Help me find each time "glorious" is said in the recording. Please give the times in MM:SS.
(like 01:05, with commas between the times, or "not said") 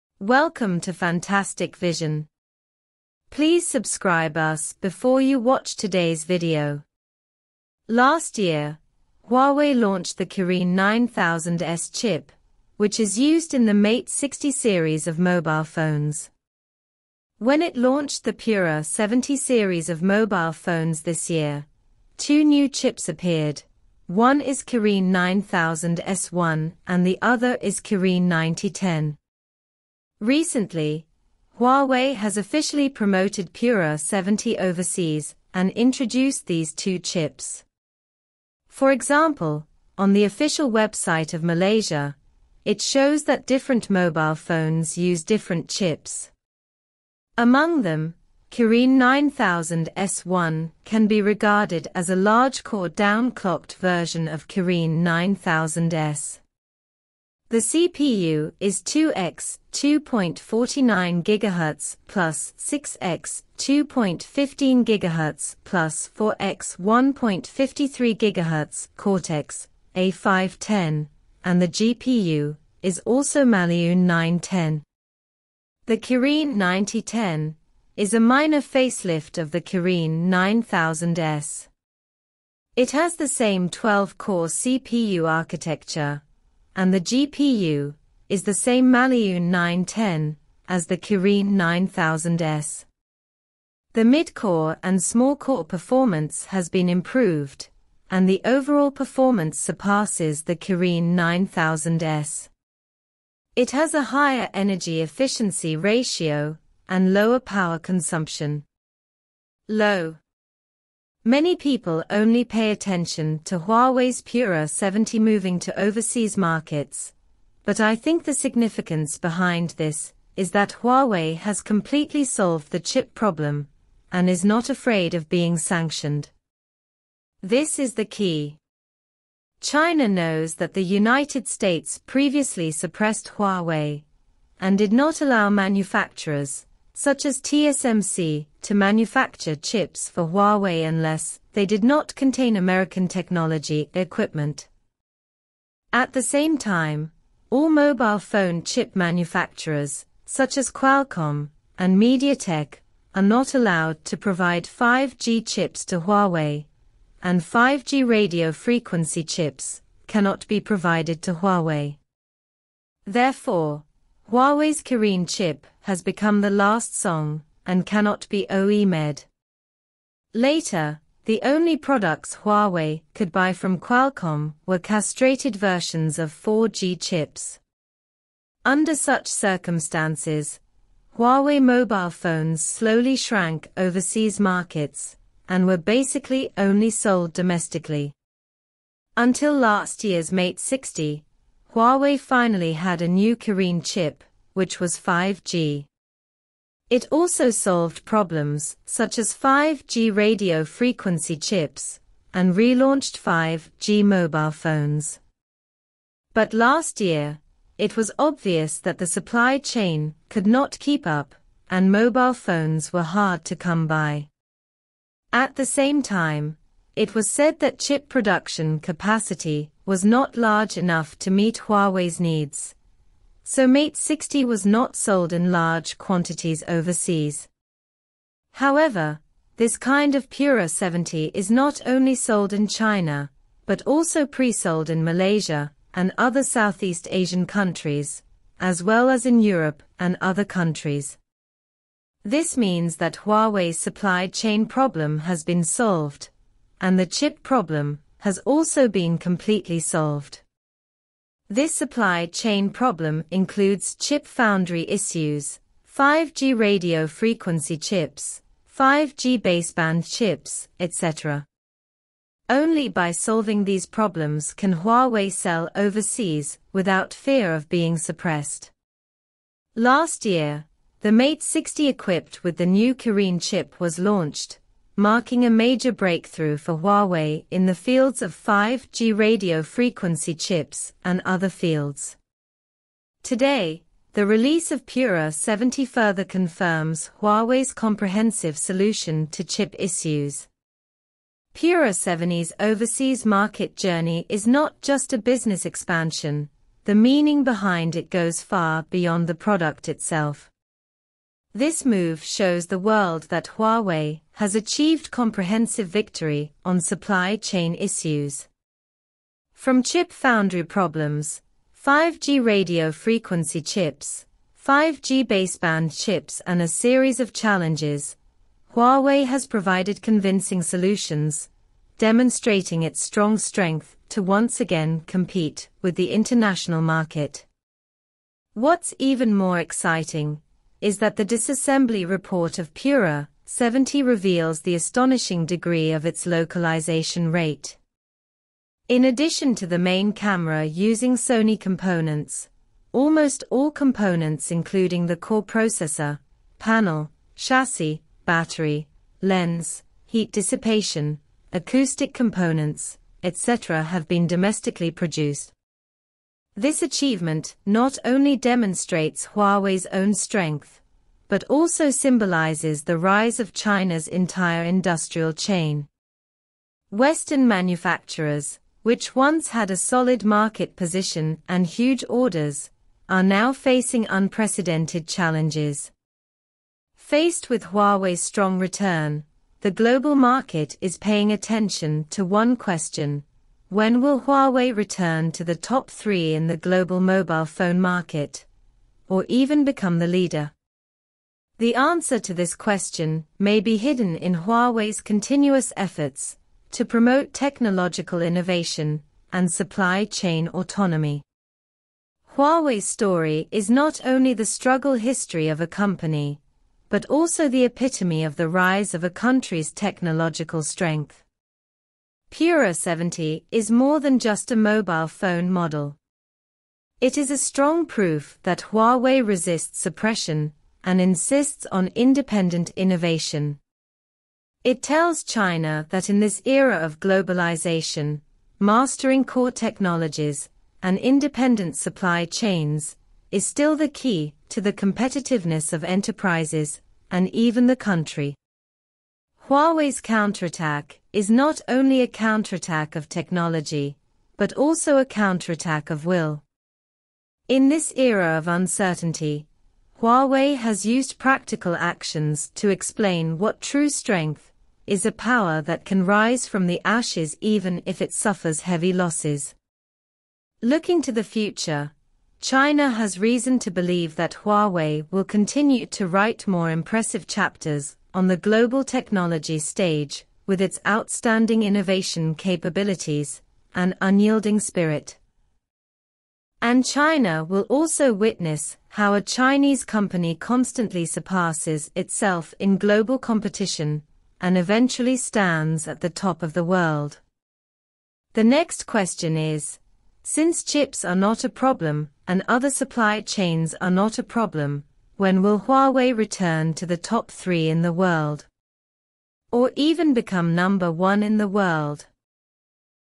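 not said.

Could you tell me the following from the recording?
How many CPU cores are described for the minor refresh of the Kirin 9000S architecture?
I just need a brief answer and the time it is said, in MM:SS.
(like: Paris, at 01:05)
12, at 01:23.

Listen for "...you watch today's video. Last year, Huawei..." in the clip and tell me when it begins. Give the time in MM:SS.
00:05.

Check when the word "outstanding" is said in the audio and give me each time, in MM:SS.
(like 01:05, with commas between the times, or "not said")
07:50.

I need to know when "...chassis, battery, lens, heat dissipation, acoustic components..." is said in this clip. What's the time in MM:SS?
05:47.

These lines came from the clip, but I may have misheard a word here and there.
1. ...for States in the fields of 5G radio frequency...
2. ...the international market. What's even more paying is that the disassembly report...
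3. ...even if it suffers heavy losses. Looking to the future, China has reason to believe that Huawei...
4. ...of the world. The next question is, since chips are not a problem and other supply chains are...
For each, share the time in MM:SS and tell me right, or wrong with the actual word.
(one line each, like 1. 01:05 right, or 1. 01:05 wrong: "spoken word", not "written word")
1. 04:36 wrong: "Huawei", not "States"
2. 05:25 wrong: "exciting", not "paying"
3. 07:37 right
4. 08:06 right.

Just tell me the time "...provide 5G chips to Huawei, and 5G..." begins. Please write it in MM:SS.
02:34.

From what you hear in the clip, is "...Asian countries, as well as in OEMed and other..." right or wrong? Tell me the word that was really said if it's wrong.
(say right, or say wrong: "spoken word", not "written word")
wrong: "Europe", not "OEMed".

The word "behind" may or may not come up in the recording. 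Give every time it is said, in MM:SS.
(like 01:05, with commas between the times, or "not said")
01:59, 04:57.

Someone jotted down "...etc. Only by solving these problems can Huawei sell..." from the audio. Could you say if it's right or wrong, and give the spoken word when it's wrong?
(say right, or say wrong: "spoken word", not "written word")
right.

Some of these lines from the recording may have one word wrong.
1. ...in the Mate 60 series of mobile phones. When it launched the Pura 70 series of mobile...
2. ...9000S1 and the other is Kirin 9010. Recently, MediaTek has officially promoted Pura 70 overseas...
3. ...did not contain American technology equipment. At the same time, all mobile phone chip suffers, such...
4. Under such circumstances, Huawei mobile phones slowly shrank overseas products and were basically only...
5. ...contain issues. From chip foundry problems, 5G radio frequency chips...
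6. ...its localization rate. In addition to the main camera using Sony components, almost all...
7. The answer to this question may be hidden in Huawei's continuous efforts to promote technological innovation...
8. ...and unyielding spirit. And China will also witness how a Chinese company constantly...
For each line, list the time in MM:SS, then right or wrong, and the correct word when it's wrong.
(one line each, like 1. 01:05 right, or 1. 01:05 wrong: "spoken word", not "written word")
1. 00:13 right
2. 00:25 wrong: "Huawei", not "MediaTek"
3. 02:21 wrong: "manufacturers", not "suffers"
4. 02:58 wrong: "markets", not "products"
5. 05:07 wrong: "chain", not "contain"
6. 05:36 right
7. 06:31 right
8. 07:53 right.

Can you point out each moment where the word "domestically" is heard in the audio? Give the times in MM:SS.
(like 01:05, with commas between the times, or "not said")
03:07, 05:54.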